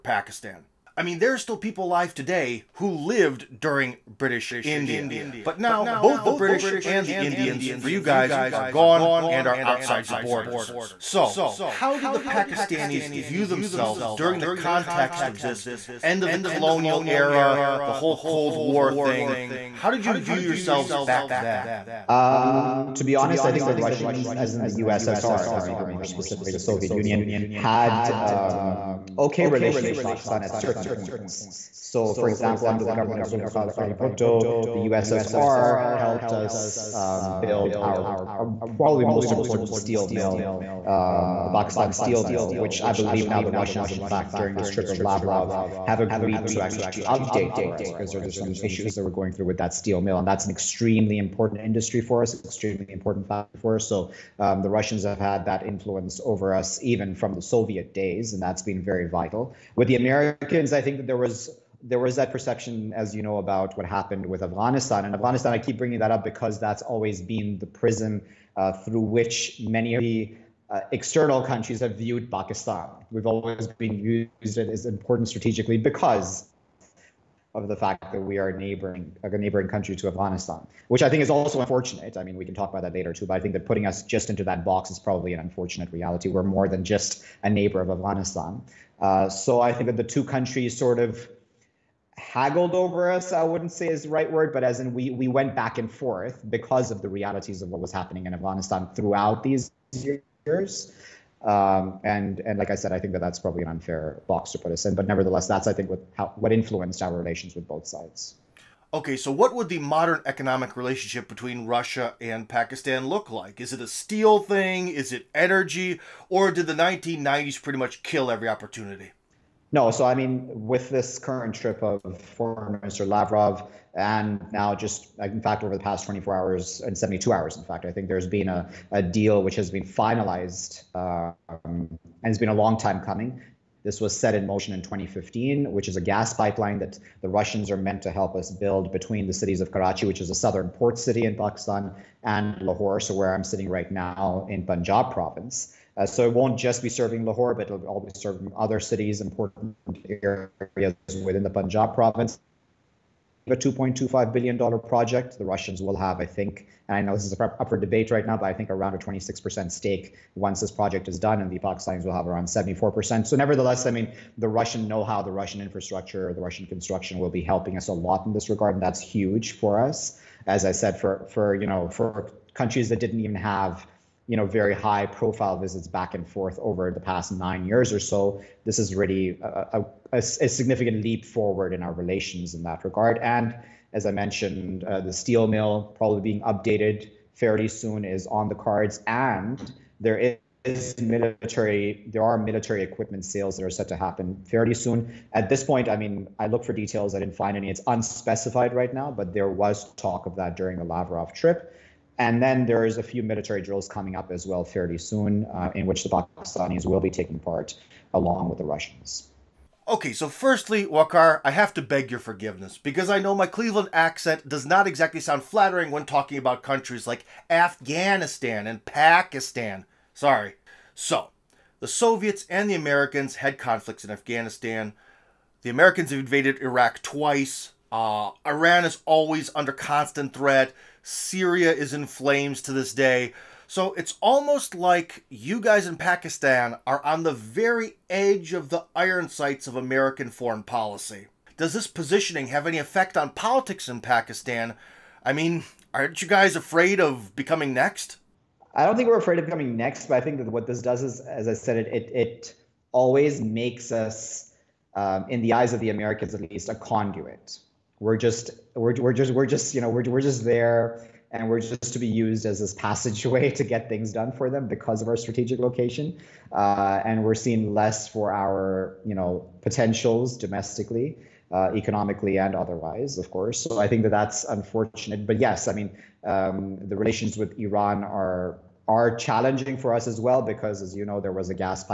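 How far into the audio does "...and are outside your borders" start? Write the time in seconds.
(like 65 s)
9 s.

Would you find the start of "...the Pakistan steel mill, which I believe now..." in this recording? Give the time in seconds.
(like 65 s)
41 s.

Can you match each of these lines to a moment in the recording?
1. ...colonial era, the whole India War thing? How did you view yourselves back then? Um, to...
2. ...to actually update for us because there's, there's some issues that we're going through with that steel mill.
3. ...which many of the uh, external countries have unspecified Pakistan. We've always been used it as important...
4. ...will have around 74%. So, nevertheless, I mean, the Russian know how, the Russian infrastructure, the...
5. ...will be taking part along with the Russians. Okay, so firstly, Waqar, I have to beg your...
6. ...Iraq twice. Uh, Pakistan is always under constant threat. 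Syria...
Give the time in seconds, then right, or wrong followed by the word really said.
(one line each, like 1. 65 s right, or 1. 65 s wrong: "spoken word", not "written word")
1. 16 s wrong: "Cold", not "India"
2. 46 s right
3. 69 s wrong: "viewed", not "unspecified"
4. 162 s right
5. 206 s right
6. 226 s wrong: "Iran", not "Pakistan".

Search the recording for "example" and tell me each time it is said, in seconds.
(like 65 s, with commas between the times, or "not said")
32 s.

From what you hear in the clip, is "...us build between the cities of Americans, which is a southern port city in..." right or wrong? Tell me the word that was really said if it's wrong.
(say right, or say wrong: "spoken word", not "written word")
wrong: "Karachi", not "Americans".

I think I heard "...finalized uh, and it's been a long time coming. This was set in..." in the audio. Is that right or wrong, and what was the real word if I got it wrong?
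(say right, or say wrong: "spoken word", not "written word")
right.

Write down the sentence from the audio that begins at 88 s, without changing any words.
Uh, so I think that the two countries sort of haggled over us.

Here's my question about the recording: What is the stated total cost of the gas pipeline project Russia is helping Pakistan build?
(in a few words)
$2.25 billion.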